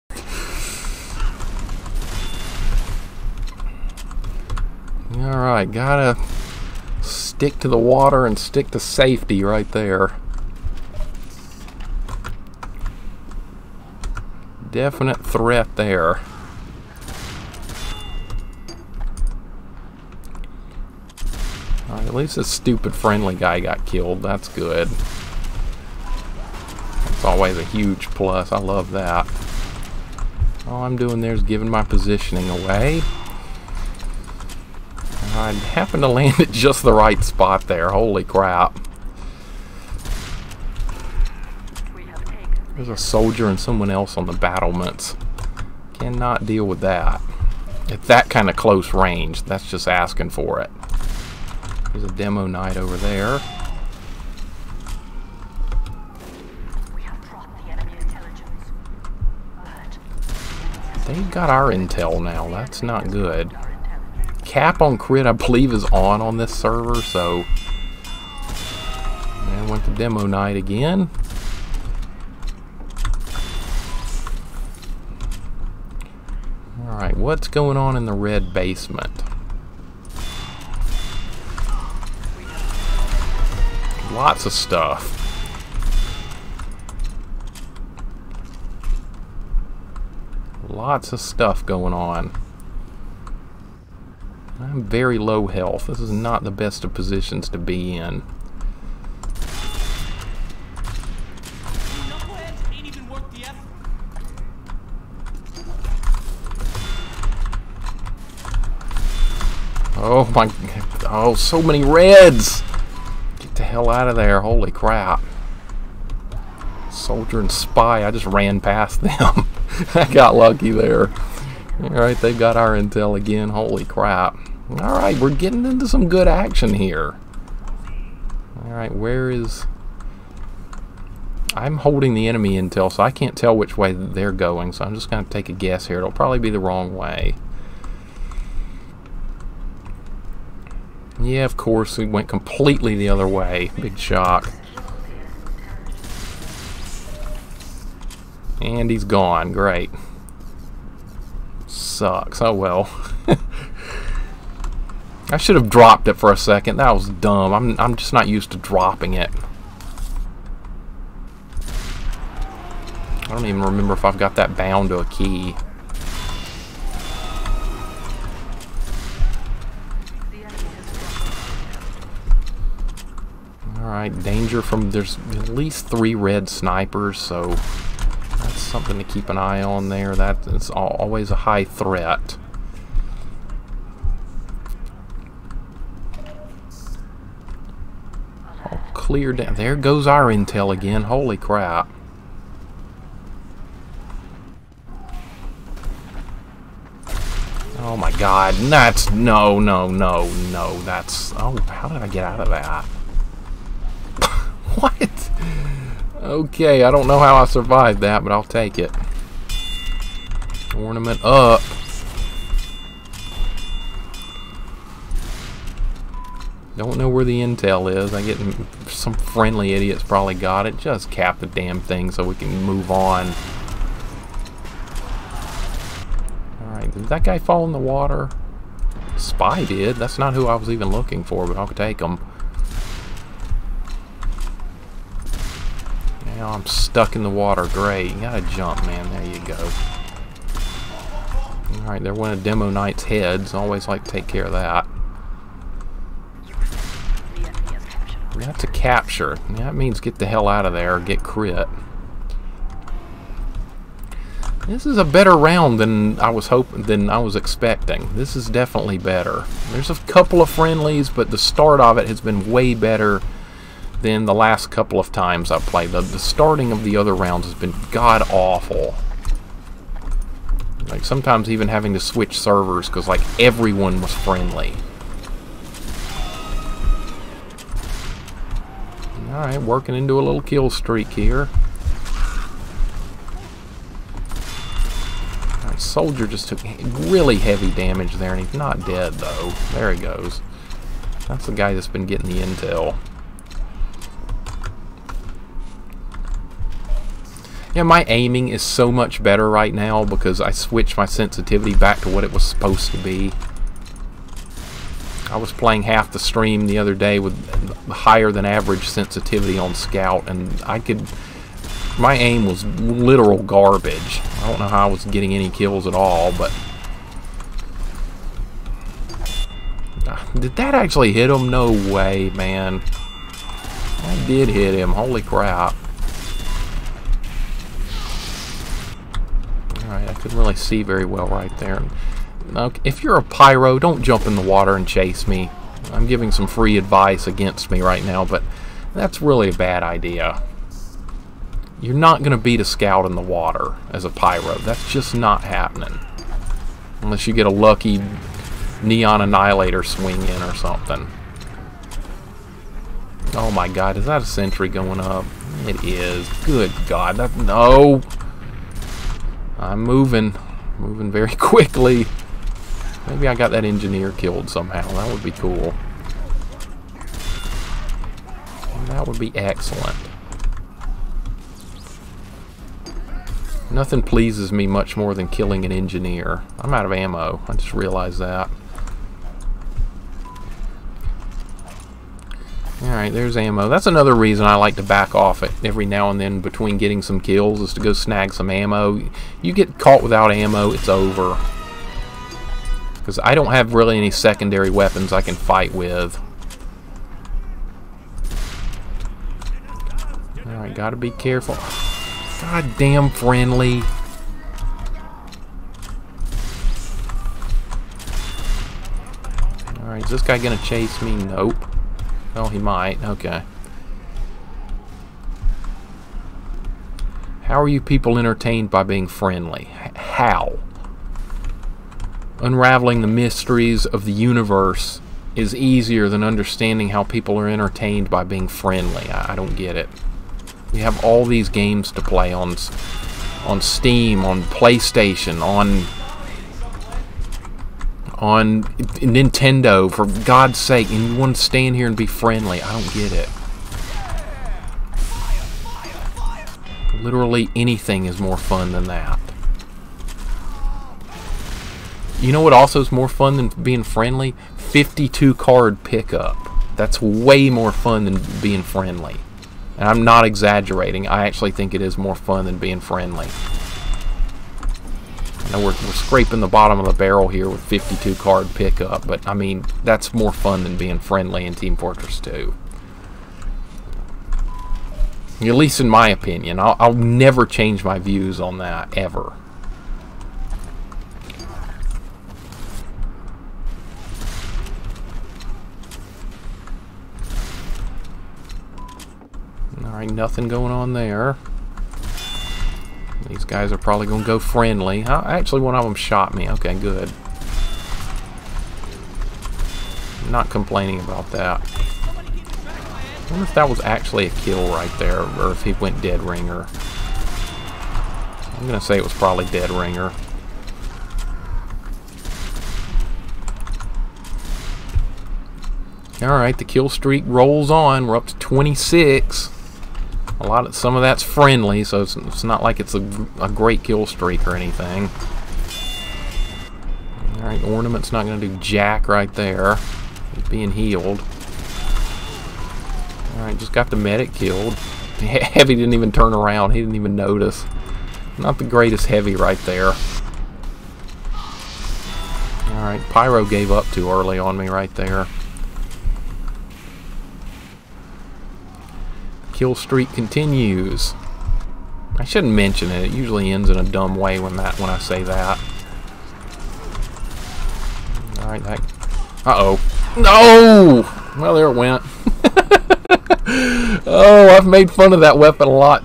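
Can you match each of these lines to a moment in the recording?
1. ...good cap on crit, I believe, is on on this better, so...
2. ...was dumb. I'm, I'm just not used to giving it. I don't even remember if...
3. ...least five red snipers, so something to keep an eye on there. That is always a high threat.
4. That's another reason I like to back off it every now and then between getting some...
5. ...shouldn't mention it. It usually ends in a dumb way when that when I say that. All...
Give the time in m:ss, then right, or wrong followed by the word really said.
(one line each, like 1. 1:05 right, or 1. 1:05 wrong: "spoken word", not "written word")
1. 1:03 wrong: "server", not "better"
2. 2:36 wrong: "dropping", not "giving"
3. 2:55 wrong: "three", not "five"
4. 6:23 right
5. 9:12 right.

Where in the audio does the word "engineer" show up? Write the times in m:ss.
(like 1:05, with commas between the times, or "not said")
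6:03, 6:15.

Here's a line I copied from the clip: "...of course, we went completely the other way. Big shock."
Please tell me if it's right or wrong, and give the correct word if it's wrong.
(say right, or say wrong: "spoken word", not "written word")
right.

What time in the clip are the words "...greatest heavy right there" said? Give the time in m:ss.
8:58.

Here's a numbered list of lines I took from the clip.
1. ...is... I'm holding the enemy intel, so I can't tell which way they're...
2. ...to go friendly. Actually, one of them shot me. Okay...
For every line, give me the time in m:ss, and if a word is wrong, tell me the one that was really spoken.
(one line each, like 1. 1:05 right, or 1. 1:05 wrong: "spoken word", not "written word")
1. 2:09 right
2. 8:14 right.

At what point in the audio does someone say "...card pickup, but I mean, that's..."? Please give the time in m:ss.
7:48.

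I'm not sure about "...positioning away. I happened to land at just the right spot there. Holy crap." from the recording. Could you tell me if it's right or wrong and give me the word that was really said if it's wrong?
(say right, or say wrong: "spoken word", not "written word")
right.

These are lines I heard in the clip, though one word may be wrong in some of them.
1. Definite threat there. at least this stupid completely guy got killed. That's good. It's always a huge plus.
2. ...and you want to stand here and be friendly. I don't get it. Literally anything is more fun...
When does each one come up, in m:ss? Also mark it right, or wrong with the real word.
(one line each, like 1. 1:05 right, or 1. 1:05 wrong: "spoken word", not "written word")
1. 0:14 wrong: "friendly", not "completely"
2. 7:20 right.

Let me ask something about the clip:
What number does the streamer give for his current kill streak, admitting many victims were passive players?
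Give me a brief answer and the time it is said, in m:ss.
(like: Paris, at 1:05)
26, at 8:38.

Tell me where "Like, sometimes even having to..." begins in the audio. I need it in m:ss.
4:30.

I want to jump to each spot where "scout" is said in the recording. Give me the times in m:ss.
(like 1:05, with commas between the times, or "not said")
5:09, 5:42.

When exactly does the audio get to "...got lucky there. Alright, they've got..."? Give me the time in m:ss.
2:00.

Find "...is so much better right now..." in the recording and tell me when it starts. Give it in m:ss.
4:58.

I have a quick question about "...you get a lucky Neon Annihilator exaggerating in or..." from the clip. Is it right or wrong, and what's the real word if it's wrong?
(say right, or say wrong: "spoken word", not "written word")
wrong: "swing", not "exaggerating".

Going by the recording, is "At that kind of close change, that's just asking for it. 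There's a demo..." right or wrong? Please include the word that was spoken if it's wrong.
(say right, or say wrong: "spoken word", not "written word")
wrong: "range", not "change".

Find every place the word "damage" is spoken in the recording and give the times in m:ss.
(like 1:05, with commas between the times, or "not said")
4:47.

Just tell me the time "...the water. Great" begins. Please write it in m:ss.
3:57.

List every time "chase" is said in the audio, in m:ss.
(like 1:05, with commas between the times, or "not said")
5:34, 6:50.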